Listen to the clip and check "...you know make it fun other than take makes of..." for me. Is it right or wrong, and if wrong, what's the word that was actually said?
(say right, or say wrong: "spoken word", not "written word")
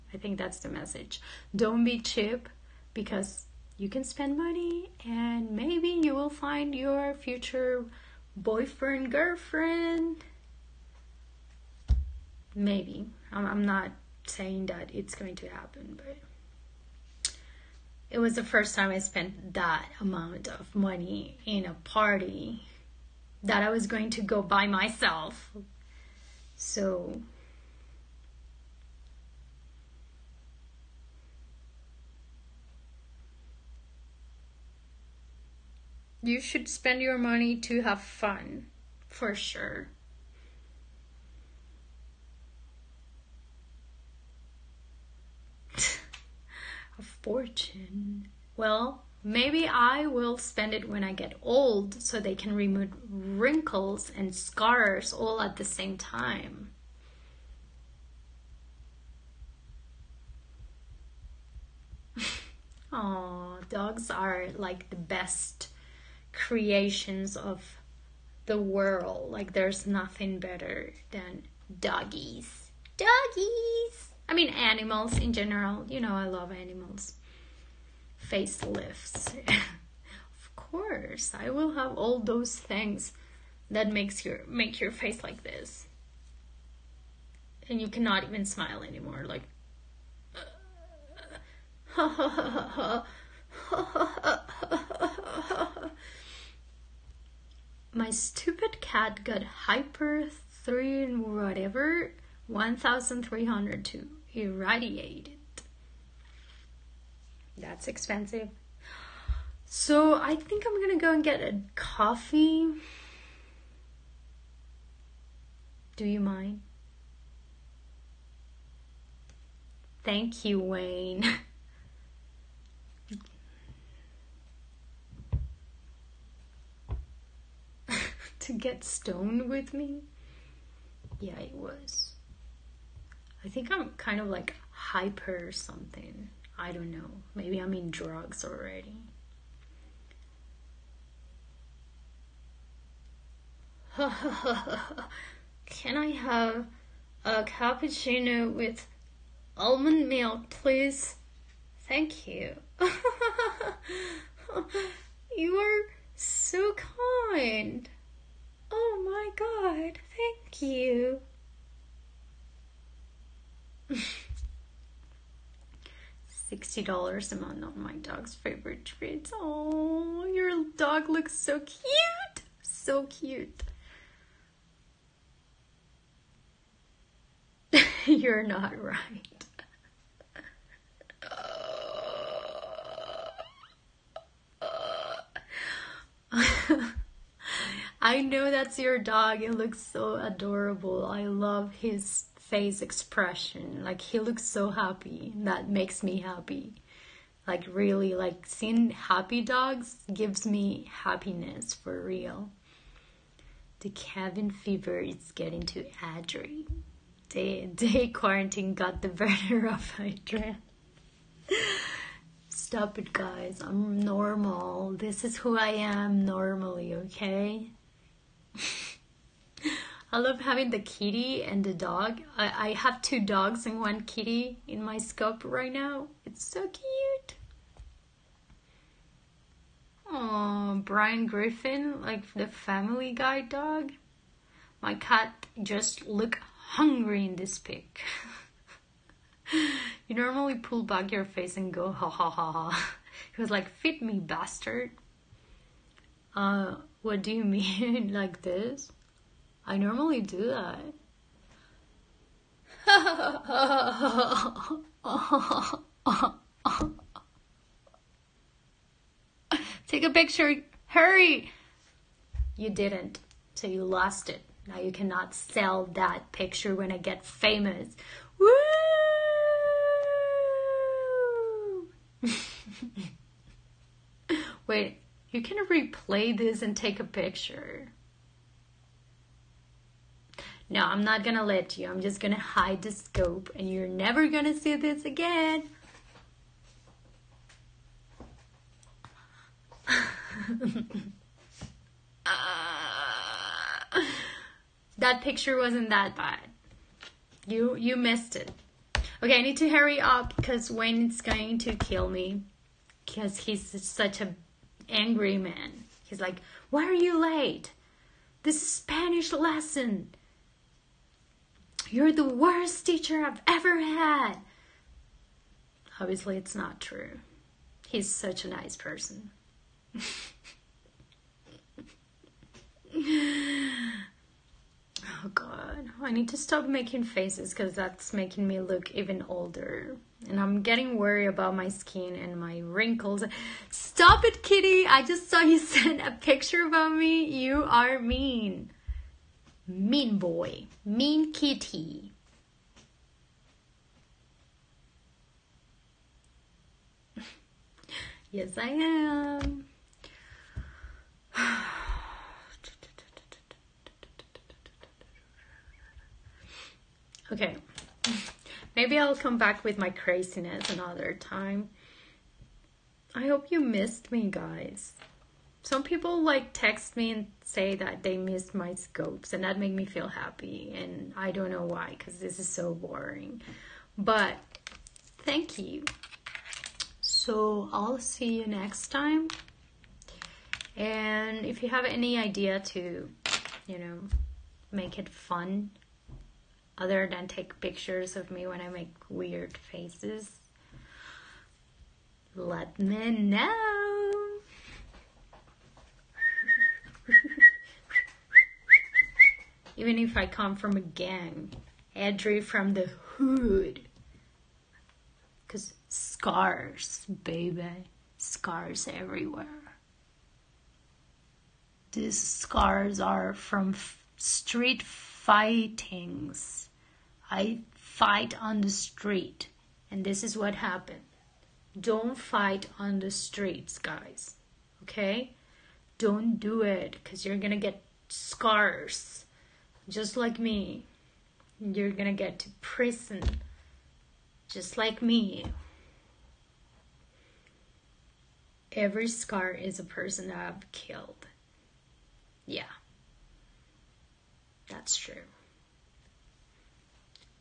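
wrong: "pictures", not "makes".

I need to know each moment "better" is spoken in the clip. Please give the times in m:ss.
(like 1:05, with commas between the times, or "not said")
1:10, 3:29.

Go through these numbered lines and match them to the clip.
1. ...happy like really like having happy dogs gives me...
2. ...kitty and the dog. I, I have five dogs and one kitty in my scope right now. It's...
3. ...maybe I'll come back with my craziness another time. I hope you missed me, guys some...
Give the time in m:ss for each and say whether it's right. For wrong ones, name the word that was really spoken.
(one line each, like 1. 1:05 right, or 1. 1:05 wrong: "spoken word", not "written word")
1. 3:16 wrong: "seeing", not "having"
2. 3:40 wrong: "two", not "five"
3. 5:58 right.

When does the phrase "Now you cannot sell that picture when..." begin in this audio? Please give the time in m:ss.
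4:24.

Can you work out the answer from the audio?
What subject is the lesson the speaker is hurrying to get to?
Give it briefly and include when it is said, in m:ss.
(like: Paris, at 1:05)
Spanish, at 5:08.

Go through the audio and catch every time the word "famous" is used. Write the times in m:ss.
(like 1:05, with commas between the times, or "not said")
4:27.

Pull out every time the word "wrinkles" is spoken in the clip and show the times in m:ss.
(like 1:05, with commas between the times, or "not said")
0:53, 5:32.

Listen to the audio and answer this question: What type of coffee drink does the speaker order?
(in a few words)
cappuccino.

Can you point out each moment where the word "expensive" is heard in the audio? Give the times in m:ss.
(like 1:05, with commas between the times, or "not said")
1:47.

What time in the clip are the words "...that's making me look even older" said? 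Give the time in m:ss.
5:27.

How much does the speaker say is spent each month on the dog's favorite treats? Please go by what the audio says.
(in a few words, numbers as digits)
$60.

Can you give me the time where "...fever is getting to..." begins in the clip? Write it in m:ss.
3:24.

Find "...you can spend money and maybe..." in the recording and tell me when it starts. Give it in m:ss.
0:03.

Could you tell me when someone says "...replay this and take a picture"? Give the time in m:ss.
4:35.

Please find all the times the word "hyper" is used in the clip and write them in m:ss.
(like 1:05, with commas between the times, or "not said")
1:39, 2:14.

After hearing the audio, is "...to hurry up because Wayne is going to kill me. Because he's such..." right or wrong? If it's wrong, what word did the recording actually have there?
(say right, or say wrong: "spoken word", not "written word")
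right.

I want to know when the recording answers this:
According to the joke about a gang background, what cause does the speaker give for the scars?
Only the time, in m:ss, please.
6:54.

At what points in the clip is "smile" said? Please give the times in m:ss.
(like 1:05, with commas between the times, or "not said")
1:28.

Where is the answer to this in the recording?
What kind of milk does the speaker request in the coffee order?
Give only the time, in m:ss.
2:29.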